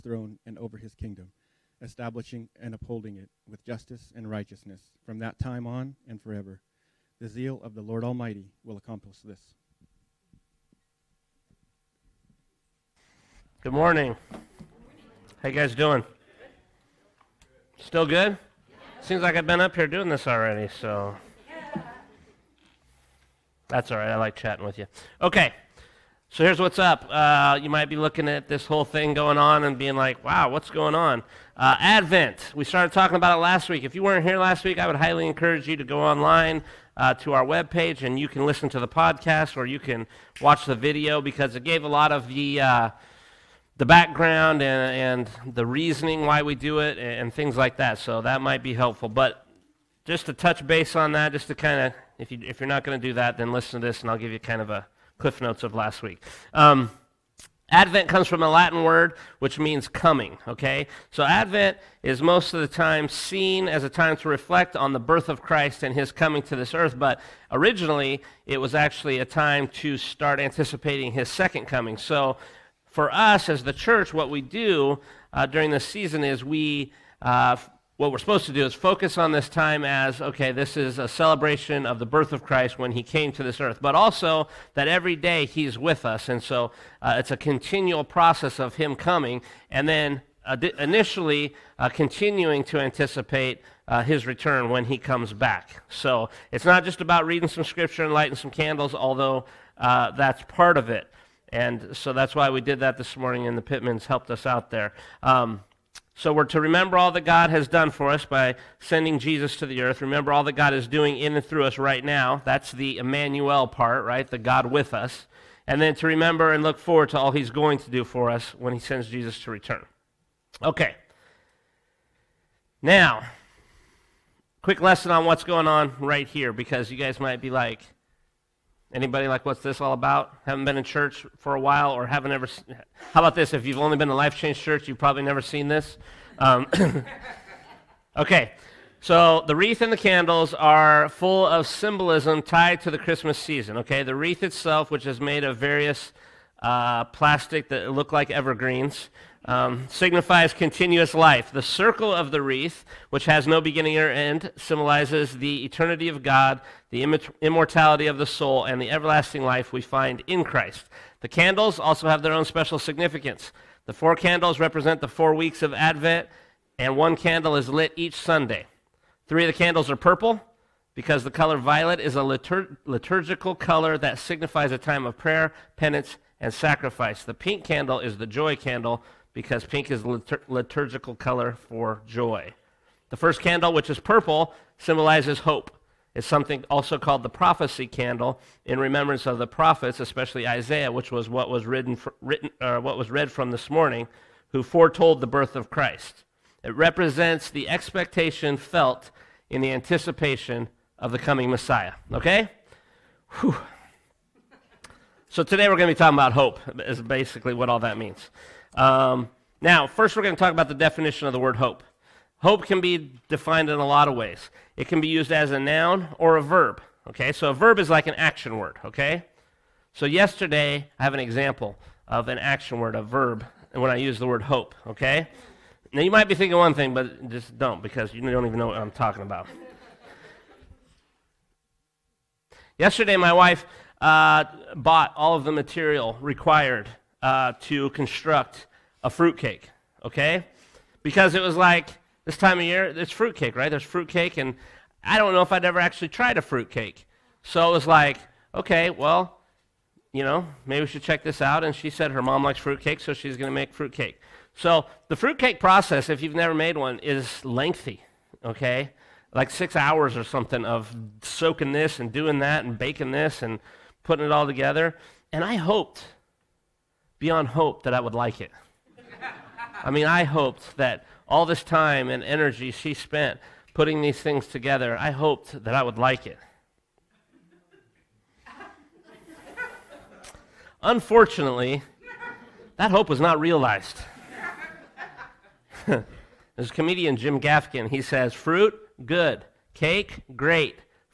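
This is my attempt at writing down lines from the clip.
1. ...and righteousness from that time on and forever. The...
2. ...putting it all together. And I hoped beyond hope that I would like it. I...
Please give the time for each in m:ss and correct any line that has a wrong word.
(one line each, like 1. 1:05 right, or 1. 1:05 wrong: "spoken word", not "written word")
1. 0:04 right
2. 4:24 right.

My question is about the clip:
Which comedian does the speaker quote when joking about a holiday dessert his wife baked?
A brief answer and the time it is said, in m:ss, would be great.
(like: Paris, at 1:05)
Jim Gaffigan, at 4:47.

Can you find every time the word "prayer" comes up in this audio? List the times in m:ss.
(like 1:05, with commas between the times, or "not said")
2:55.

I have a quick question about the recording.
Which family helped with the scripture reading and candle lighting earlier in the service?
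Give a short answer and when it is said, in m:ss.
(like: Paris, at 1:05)
The Pittmans, at 1:43.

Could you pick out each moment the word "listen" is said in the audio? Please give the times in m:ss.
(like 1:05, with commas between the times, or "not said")
0:38, 0:53.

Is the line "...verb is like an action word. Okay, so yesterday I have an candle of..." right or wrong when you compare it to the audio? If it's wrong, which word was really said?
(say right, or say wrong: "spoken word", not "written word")
wrong: "example", not "candle".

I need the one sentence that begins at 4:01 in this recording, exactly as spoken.
Because it was like this time of year, it's fruitcake, right?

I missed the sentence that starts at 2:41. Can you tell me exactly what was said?
The candles also have their own special significance.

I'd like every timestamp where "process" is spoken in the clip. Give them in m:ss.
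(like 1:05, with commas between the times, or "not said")
1:28, 4:15.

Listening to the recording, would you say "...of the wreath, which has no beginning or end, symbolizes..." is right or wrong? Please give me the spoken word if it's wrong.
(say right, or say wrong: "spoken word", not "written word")
right.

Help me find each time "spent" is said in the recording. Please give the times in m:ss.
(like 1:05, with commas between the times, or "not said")
4:32.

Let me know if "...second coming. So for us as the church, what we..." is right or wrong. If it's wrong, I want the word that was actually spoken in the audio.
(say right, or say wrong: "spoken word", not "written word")
right.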